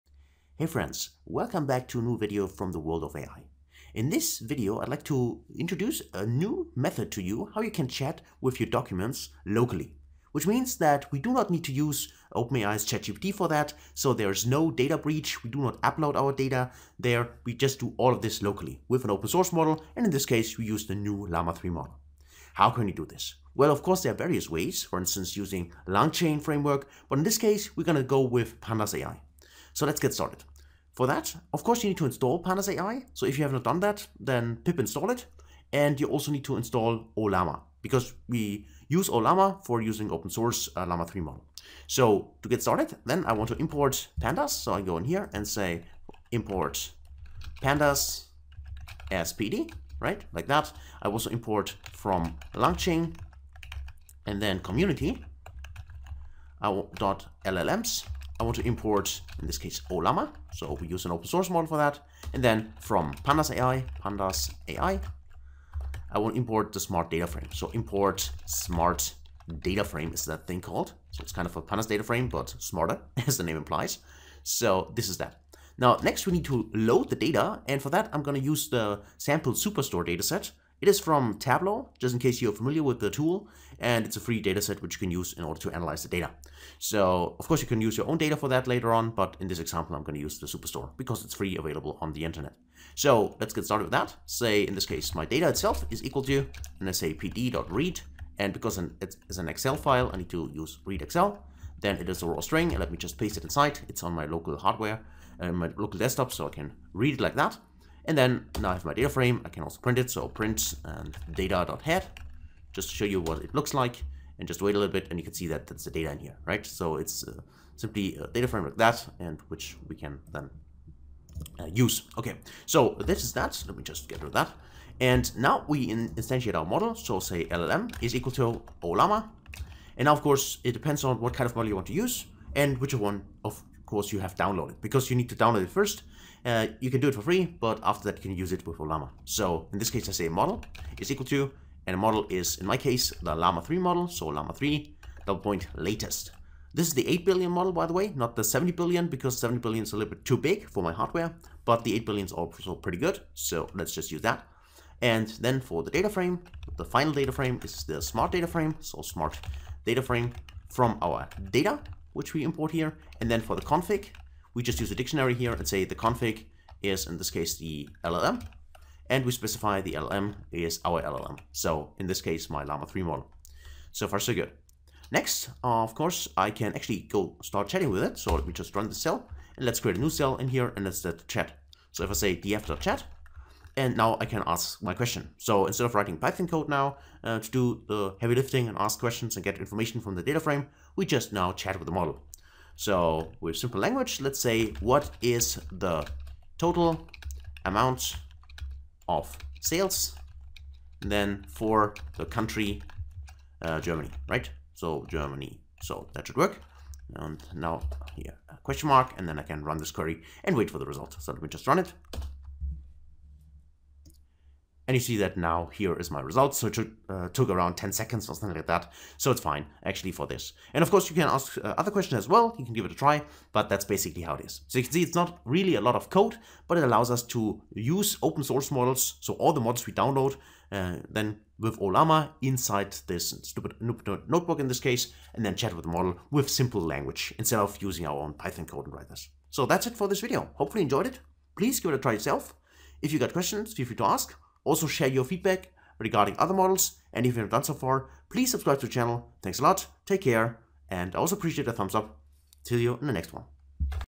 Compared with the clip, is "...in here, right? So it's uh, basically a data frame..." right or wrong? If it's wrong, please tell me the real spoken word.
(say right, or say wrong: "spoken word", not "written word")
wrong: "simply", not "basically".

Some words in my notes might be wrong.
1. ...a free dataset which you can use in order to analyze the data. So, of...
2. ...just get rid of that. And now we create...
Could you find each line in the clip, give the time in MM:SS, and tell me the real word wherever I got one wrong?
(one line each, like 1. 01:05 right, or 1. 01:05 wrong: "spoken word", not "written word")
1. 01:24 right
2. 02:03 wrong: "instantiate", not "create".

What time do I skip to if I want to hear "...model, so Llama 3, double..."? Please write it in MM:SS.
02:23.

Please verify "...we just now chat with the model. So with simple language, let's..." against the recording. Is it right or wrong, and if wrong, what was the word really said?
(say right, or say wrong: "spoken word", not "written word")
right.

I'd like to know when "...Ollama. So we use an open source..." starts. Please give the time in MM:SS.
00:59.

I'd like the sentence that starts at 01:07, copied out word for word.
So import smart data frame is that thing called.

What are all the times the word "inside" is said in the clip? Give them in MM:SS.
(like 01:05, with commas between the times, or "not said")
01:43, 03:52.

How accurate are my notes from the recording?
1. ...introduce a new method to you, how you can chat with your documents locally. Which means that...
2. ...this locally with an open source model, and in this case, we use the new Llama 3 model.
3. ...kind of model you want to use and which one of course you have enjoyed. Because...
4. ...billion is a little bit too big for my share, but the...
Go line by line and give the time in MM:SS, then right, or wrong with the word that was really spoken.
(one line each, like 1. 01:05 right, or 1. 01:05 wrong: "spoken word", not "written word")
1. 00:05 right
2. 00:18 right
3. 02:11 wrong: "downloaded", not "enjoyed"
4. 02:29 wrong: "hardware", not "share".